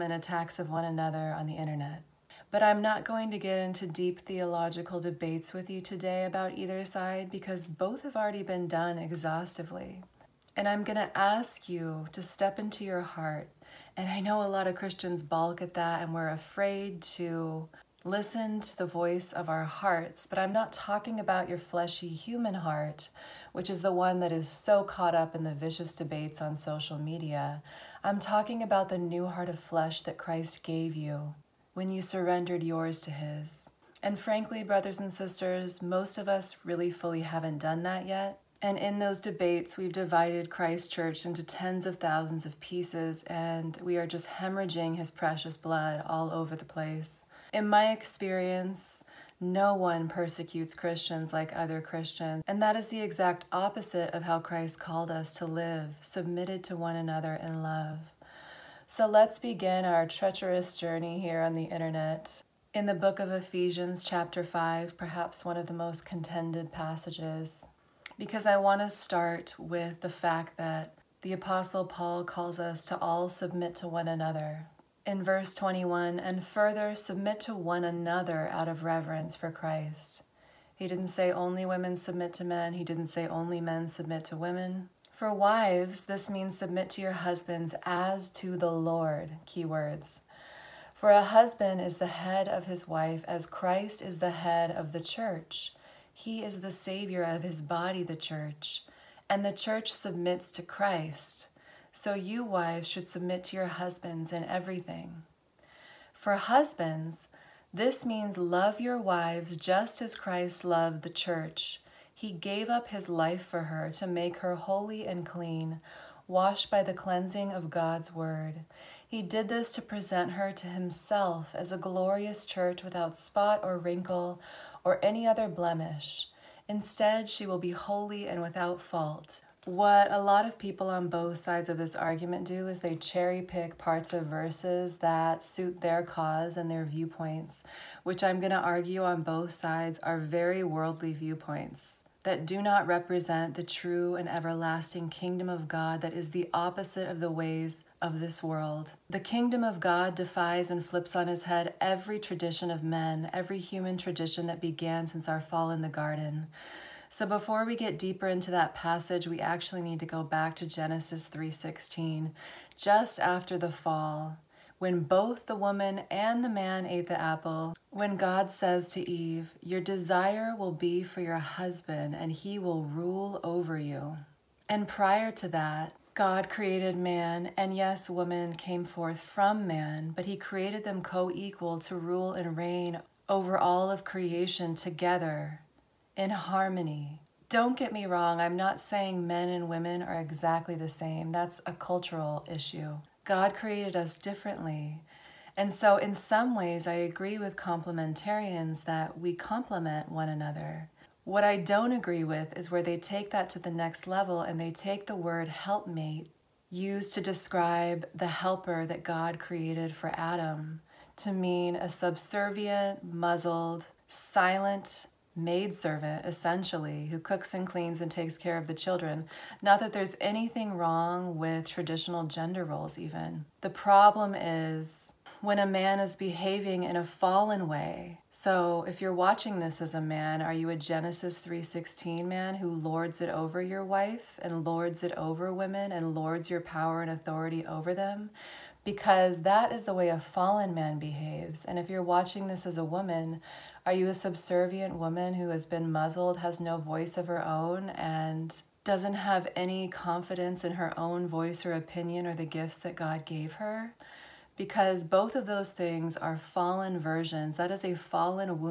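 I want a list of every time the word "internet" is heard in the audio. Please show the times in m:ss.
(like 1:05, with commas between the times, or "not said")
0:01, 1:01.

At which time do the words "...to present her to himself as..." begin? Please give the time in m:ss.
1:59.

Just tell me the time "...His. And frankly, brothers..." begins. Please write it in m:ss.
0:33.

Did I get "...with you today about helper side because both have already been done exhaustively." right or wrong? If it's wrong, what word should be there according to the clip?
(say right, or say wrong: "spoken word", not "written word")
wrong: "either", not "helper".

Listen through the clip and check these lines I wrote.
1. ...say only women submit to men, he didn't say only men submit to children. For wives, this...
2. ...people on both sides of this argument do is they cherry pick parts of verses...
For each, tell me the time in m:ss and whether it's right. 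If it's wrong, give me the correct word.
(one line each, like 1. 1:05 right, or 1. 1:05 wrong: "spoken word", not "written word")
1. 1:21 wrong: "women", not "children"
2. 2:10 right.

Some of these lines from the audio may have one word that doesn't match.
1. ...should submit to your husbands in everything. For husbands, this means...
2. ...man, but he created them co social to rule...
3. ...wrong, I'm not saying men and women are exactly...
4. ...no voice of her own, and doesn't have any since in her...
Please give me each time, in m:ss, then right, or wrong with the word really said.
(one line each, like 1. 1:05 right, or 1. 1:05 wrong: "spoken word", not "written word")
1. 1:42 right
2. 2:59 wrong: "equal", not "social"
3. 3:08 right
4. 4:06 wrong: "confidence", not "since".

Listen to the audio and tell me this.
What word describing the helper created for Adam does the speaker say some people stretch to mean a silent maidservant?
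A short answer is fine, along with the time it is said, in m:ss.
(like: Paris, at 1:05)
helpmate, at 3:25.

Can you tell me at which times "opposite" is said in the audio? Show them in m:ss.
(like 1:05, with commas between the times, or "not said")
0:53, 2:26.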